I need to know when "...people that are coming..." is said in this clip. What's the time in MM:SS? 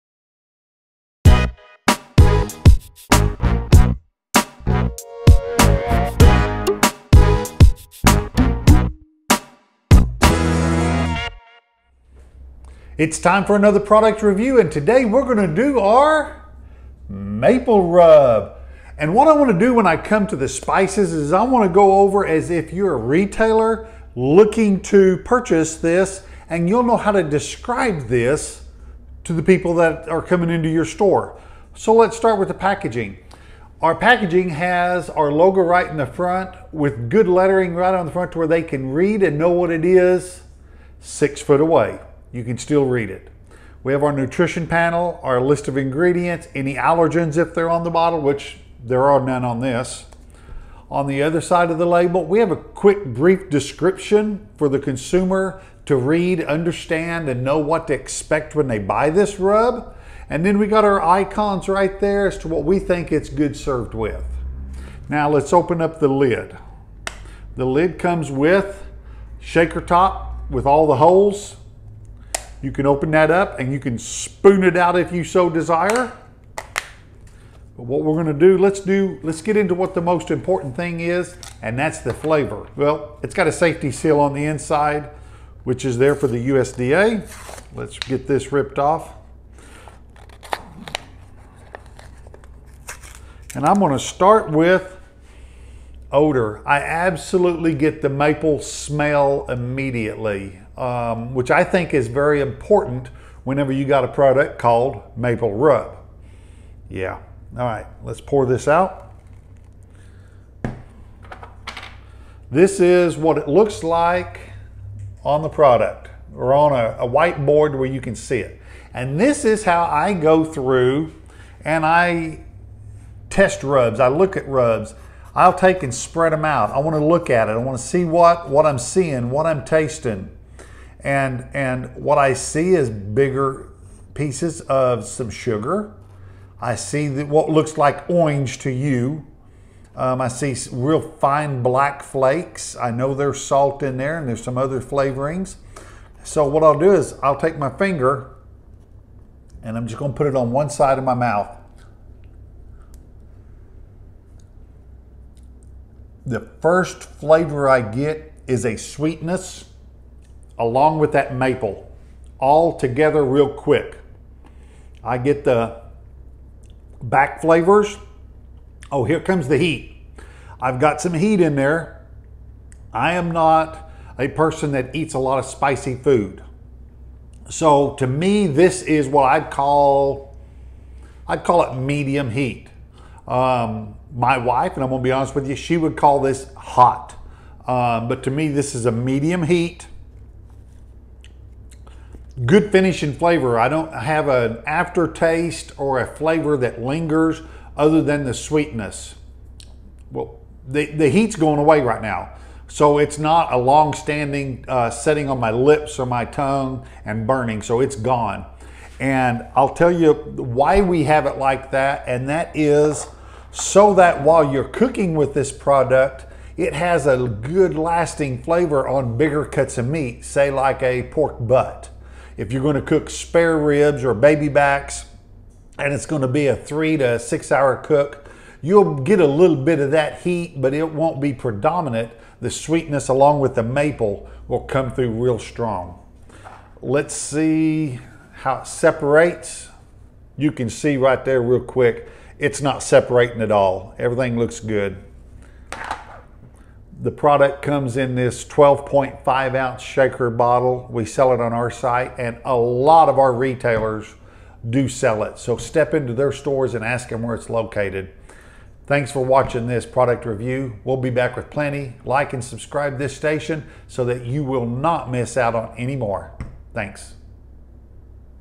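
00:29.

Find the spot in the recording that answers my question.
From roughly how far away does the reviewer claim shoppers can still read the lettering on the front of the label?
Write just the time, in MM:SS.
00:40.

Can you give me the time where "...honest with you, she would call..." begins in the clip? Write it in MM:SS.
03:05.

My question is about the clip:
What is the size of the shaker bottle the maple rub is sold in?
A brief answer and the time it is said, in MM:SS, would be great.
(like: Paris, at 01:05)
12.5 ounces, at 04:08.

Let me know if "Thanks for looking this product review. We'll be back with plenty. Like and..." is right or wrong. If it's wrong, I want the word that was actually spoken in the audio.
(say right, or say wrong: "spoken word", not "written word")
wrong: "watching", not "looking".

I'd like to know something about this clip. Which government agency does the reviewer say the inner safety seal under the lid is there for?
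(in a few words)
USDA.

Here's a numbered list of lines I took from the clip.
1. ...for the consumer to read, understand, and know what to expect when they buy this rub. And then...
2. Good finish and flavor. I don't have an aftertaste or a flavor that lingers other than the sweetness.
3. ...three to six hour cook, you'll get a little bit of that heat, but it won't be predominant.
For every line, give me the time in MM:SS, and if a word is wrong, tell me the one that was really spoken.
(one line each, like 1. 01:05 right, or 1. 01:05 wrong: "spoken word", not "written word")
1. 00:54 right
2. 03:12 right
3. 03:46 right.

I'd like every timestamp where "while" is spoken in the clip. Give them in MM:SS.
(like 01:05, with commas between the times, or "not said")
03:34.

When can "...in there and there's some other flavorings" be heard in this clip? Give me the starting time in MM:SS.
02:23.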